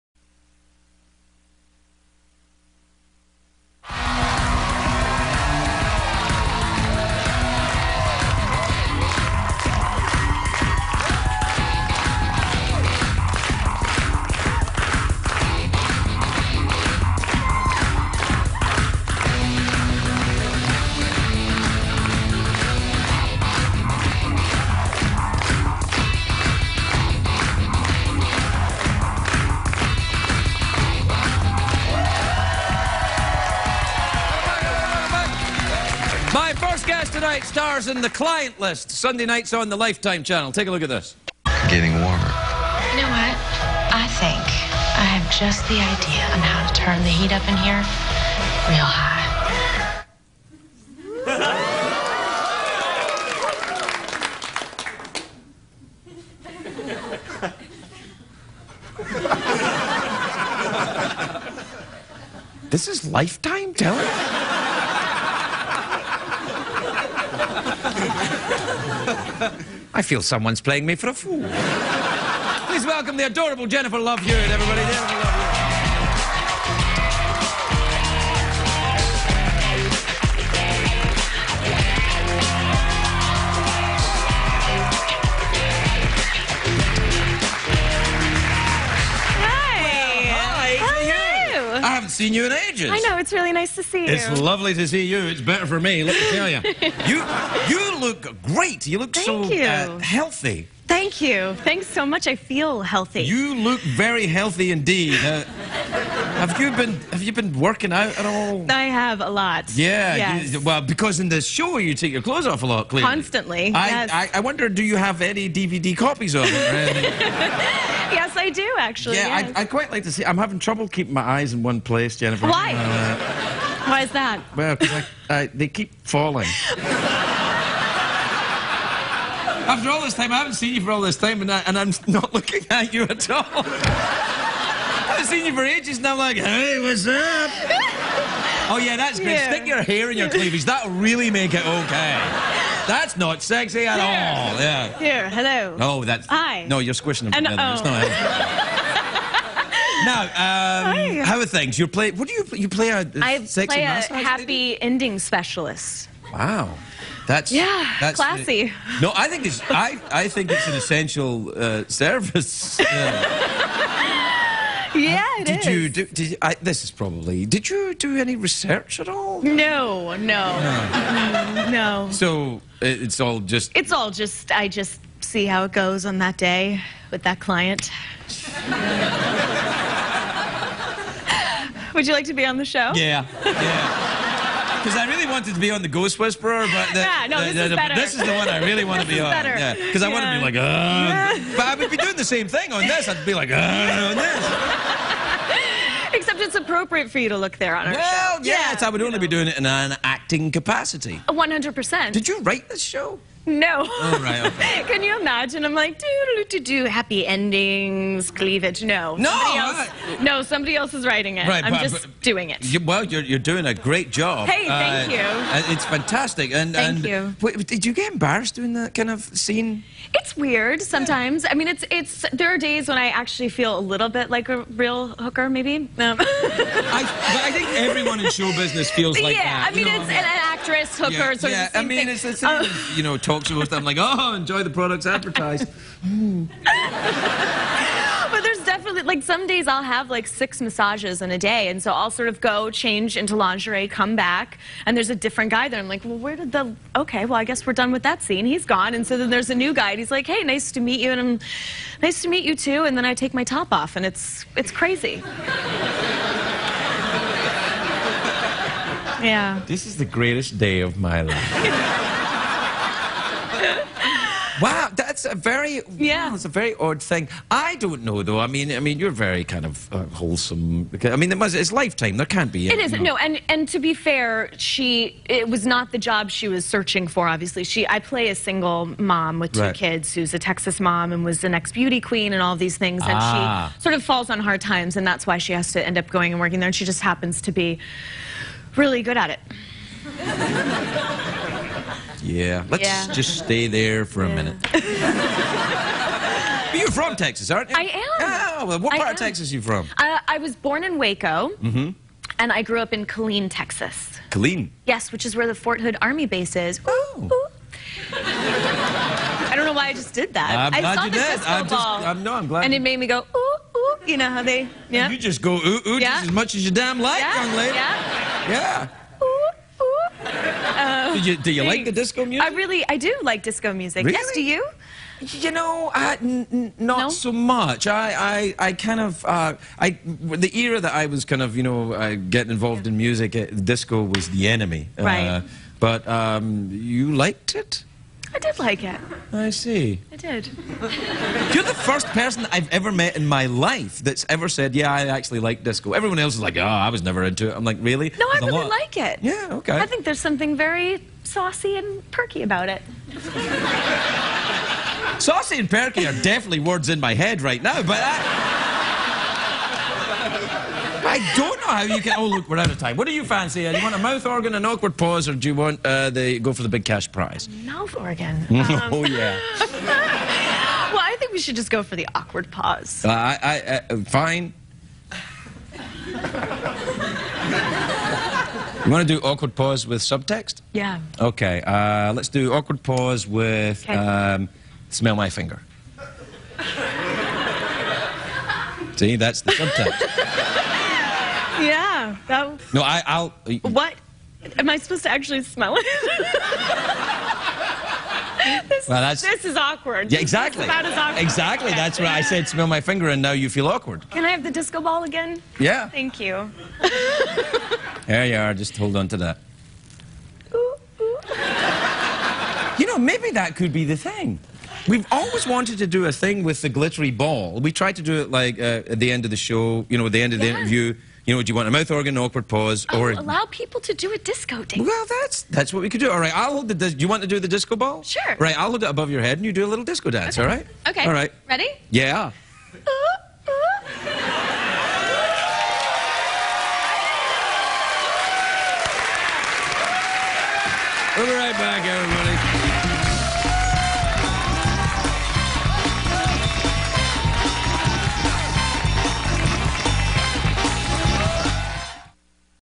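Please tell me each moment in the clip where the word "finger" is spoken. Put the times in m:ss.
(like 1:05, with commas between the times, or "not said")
6:25, 6:42.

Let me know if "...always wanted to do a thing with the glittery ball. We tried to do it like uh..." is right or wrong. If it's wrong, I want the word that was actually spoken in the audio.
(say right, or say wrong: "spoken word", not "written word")
right.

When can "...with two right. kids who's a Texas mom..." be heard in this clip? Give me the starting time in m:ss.
4:39.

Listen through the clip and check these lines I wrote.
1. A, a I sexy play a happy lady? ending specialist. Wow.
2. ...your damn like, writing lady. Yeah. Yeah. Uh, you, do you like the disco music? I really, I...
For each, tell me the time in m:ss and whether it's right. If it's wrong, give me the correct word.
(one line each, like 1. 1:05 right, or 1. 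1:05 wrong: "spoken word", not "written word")
1. 2:32 right
2. 5:16 wrong: "young", not "writing".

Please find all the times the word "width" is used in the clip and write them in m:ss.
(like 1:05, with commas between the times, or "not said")
not said.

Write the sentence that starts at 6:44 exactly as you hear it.
Can I have the disco ball again?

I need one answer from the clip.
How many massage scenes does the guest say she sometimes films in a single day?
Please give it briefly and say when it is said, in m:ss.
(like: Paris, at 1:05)
6, at 4:00.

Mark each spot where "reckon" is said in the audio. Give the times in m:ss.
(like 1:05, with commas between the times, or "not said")
not said.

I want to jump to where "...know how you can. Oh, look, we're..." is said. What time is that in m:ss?
6:01.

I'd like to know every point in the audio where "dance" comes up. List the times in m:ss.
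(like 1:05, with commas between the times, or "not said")
7:04, 7:10.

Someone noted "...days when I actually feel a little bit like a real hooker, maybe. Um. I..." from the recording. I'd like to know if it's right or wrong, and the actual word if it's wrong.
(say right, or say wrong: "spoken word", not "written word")
right.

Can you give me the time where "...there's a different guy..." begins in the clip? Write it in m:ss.
4:04.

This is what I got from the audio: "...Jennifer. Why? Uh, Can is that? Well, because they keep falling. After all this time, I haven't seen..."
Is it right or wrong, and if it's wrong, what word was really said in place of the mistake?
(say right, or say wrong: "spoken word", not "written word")
wrong: "Why", not "Can".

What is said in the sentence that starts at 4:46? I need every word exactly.
And she just happens to be really good at it.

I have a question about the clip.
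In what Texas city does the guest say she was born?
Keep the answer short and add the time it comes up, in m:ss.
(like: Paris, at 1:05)
Waco, at 5:00.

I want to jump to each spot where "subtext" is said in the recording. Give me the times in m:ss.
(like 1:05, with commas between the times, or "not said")
6:20, 6:29.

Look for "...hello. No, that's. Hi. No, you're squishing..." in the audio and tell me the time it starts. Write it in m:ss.
2:25.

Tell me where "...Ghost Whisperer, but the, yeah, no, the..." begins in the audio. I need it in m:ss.
3:05.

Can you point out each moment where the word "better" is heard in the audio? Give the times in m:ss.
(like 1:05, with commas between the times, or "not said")
1:35, 3:09.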